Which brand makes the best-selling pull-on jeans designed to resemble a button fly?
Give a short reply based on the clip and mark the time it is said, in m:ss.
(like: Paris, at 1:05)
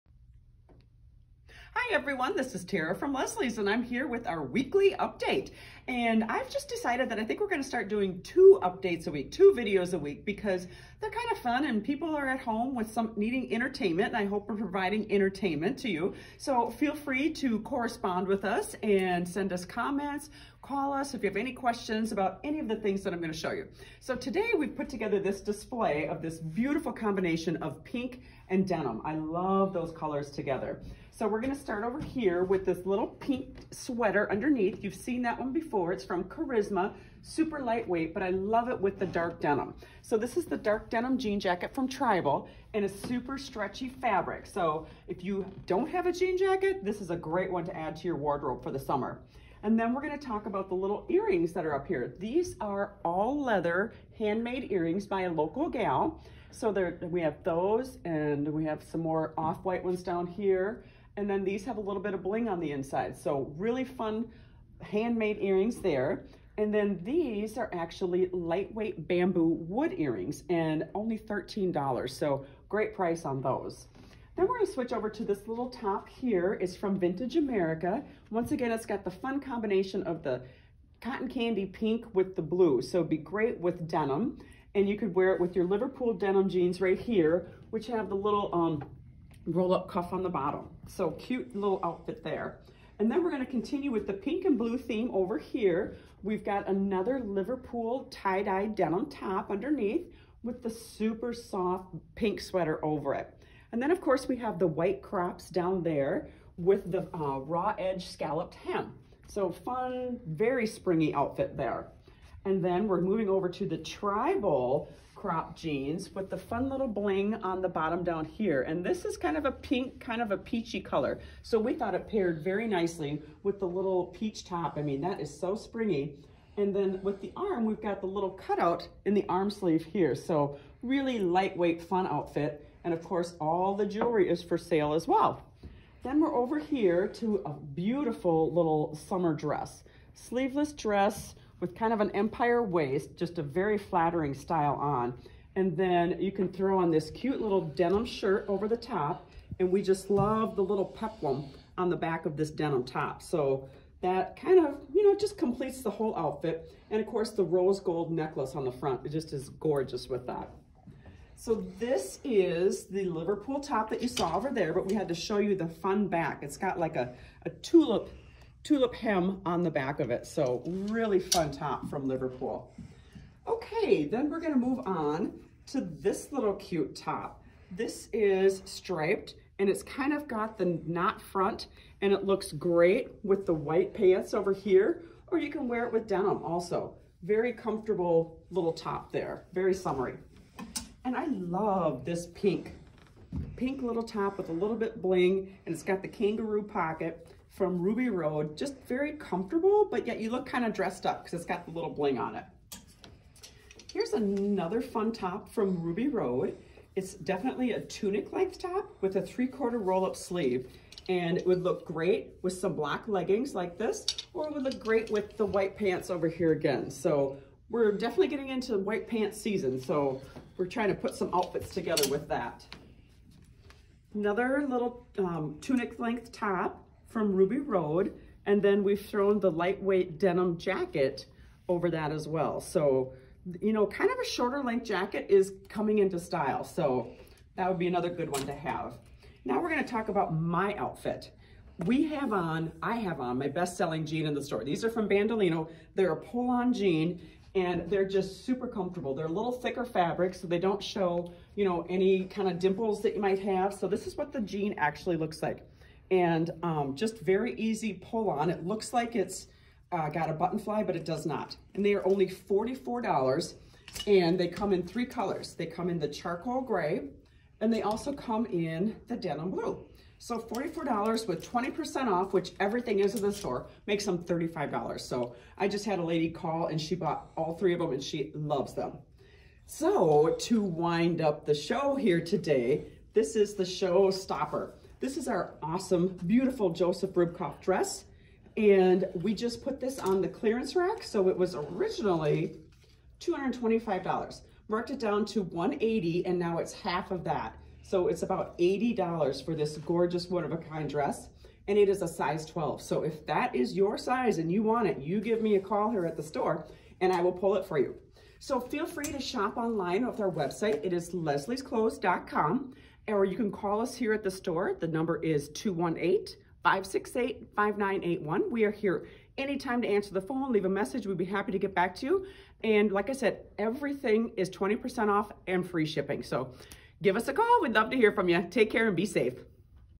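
Bandolino, at 4:05.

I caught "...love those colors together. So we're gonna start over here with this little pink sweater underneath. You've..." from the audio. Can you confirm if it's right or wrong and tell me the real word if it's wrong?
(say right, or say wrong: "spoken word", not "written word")
right.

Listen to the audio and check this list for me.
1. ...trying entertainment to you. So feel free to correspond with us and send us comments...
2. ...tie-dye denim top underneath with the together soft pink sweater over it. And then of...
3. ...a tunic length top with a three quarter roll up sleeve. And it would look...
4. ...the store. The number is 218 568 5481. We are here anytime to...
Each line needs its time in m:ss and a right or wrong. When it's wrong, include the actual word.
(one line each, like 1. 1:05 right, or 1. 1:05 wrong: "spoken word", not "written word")
1. 0:14 wrong: "providing", not "trying"
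2. 1:38 wrong: "super", not "together"
3. 3:27 right
4. 5:14 wrong: "5981", not "5481".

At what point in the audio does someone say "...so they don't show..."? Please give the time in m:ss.
4:10.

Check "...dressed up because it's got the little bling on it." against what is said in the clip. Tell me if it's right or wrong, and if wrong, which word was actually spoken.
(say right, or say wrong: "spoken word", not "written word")
right.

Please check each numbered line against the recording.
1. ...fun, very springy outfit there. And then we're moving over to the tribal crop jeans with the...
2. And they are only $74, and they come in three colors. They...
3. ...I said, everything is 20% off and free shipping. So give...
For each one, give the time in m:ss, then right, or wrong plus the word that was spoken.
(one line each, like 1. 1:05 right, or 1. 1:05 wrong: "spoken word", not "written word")
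1. 1:49 right
2. 4:21 wrong: "44", not "74"
3. 5:23 right.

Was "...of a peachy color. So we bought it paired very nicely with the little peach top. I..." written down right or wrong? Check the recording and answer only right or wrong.
wrong.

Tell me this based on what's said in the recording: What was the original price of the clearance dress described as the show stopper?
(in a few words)
$225.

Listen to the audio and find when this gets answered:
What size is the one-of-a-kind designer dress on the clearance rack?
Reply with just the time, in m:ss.
5:02.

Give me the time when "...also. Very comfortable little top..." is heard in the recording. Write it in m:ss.
3:06.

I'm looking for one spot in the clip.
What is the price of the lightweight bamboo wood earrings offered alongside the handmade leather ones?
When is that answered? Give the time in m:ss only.
1:11.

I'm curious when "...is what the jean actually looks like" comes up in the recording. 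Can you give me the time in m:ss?
4:14.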